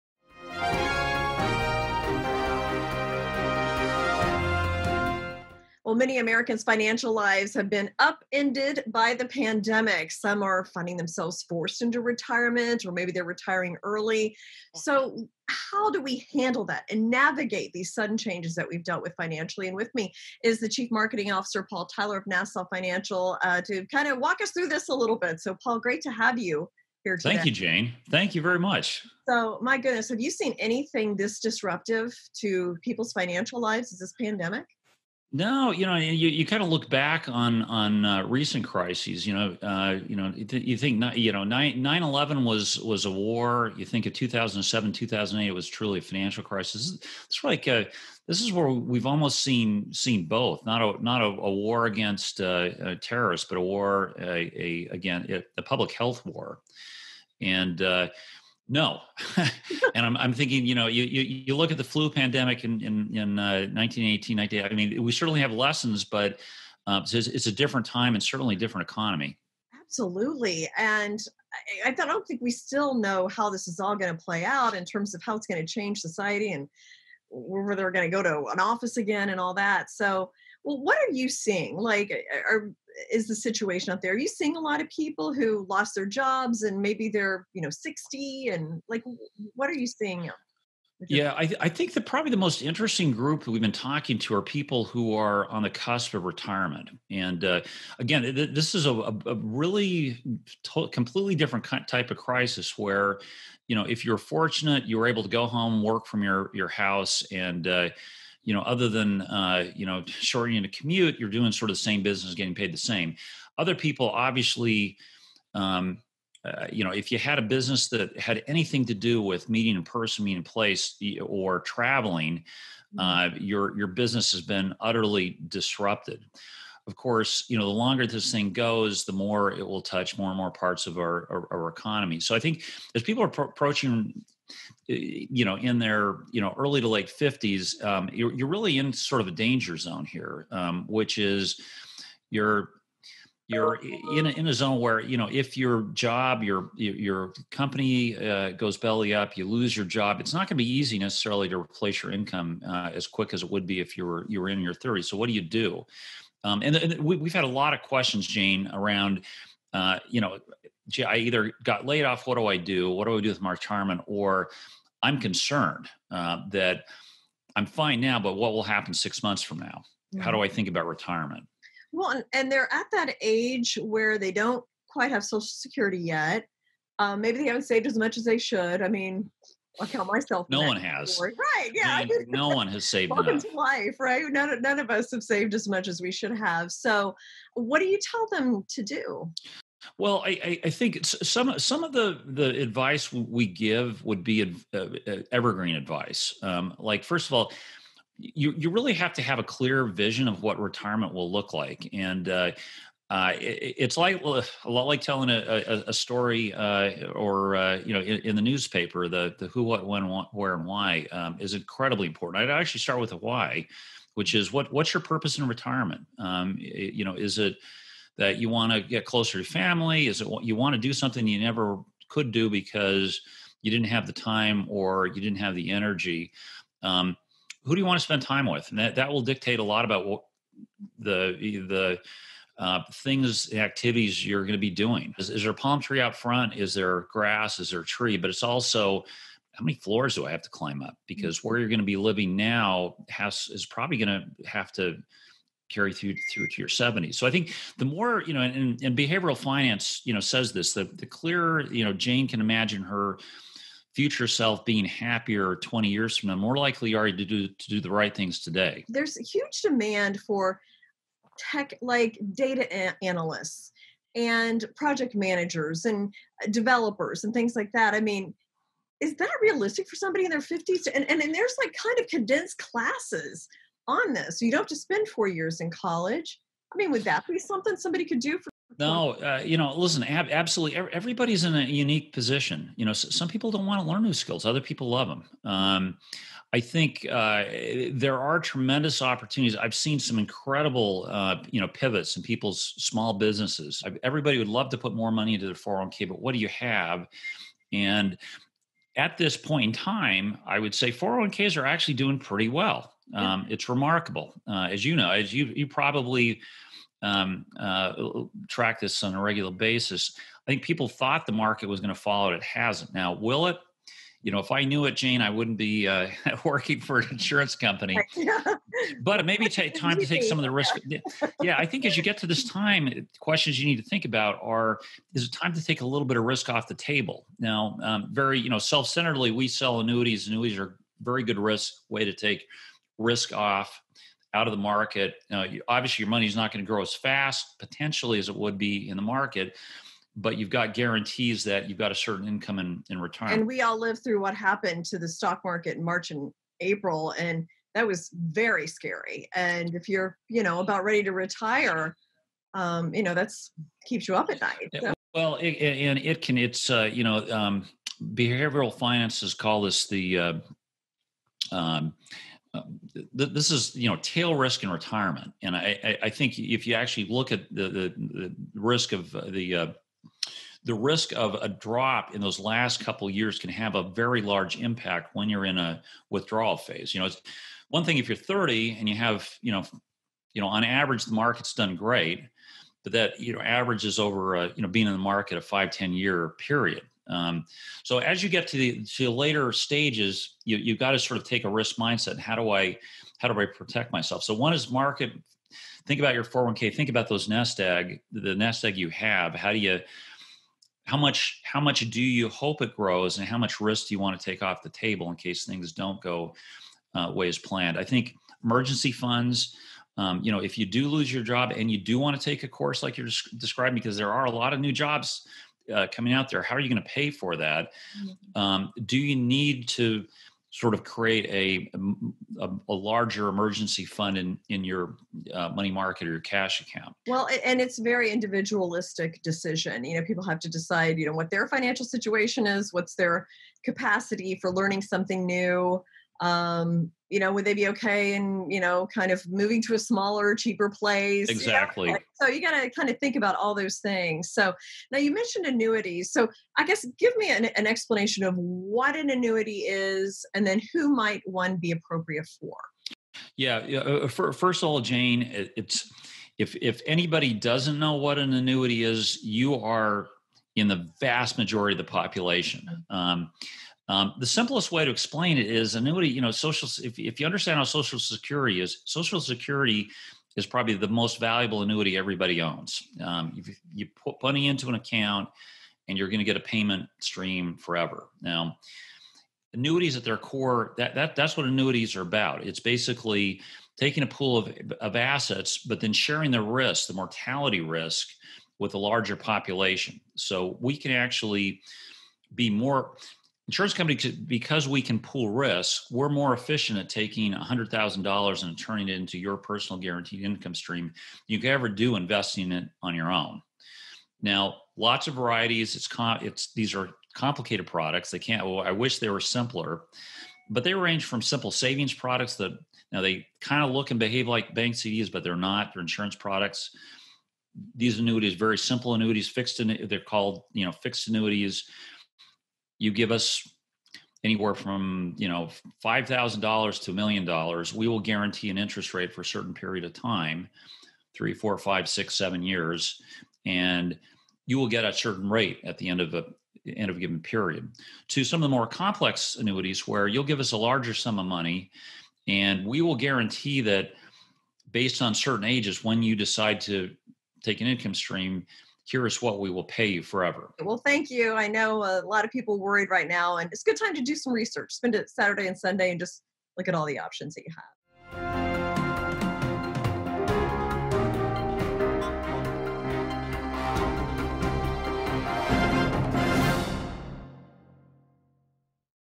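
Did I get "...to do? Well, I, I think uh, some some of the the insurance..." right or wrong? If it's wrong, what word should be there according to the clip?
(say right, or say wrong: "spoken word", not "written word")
wrong: "advice", not "insurance".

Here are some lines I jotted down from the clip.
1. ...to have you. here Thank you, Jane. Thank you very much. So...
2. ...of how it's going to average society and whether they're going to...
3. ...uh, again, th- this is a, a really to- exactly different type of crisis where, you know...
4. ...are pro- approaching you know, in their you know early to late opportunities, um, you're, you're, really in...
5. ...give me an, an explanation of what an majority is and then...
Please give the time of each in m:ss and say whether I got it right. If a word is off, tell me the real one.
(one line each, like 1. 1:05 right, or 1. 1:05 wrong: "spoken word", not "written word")
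1. 0:26 right
2. 1:15 wrong: "change", not "average"
3. 1:37 wrong: "completely", not "exactly"
4. 2:13 wrong: "fifties", not "opportunities"
5. 7:26 wrong: "annuity", not "majority".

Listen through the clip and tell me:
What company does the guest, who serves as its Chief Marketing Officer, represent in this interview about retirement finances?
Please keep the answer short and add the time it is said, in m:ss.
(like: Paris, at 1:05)
Nassau Financial, at 0:22.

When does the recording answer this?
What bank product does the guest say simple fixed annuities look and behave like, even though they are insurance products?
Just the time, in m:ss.
8:34.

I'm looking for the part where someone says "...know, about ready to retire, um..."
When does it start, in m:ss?
5:50.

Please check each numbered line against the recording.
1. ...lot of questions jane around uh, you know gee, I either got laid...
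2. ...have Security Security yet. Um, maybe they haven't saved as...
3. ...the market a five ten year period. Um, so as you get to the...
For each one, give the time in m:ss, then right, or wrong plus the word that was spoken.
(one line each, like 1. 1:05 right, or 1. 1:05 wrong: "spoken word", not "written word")
1. 2:37 right
2. 2:55 wrong: "Social", not "Security"
3. 6:24 right.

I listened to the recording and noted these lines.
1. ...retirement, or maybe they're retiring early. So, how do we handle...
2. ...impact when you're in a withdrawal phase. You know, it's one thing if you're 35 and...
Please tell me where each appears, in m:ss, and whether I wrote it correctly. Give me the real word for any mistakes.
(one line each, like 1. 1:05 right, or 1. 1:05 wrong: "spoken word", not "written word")
1. 0:11 right
2. 6:14 wrong: "30", not "35".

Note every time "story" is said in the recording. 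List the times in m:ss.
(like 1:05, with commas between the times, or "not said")
3:25.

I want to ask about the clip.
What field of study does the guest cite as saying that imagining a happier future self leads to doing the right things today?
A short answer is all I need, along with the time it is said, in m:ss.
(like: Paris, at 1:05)
Behavioral finance, at 4:08.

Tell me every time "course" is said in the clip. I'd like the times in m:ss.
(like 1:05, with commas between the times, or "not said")
2:06, 6:52.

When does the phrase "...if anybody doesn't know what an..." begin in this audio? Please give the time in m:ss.
7:36.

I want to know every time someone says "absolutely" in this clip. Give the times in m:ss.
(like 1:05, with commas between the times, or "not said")
1:09, 4:40.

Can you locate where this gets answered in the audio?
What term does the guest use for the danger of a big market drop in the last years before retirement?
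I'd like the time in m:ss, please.
6:04.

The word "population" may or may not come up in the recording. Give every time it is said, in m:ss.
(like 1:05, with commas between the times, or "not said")
7:41, 8:09.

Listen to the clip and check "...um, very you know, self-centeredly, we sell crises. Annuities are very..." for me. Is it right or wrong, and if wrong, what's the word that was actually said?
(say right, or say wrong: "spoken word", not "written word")
wrong: "annuities", not "crises".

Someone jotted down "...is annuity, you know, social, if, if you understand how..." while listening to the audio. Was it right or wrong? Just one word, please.
right.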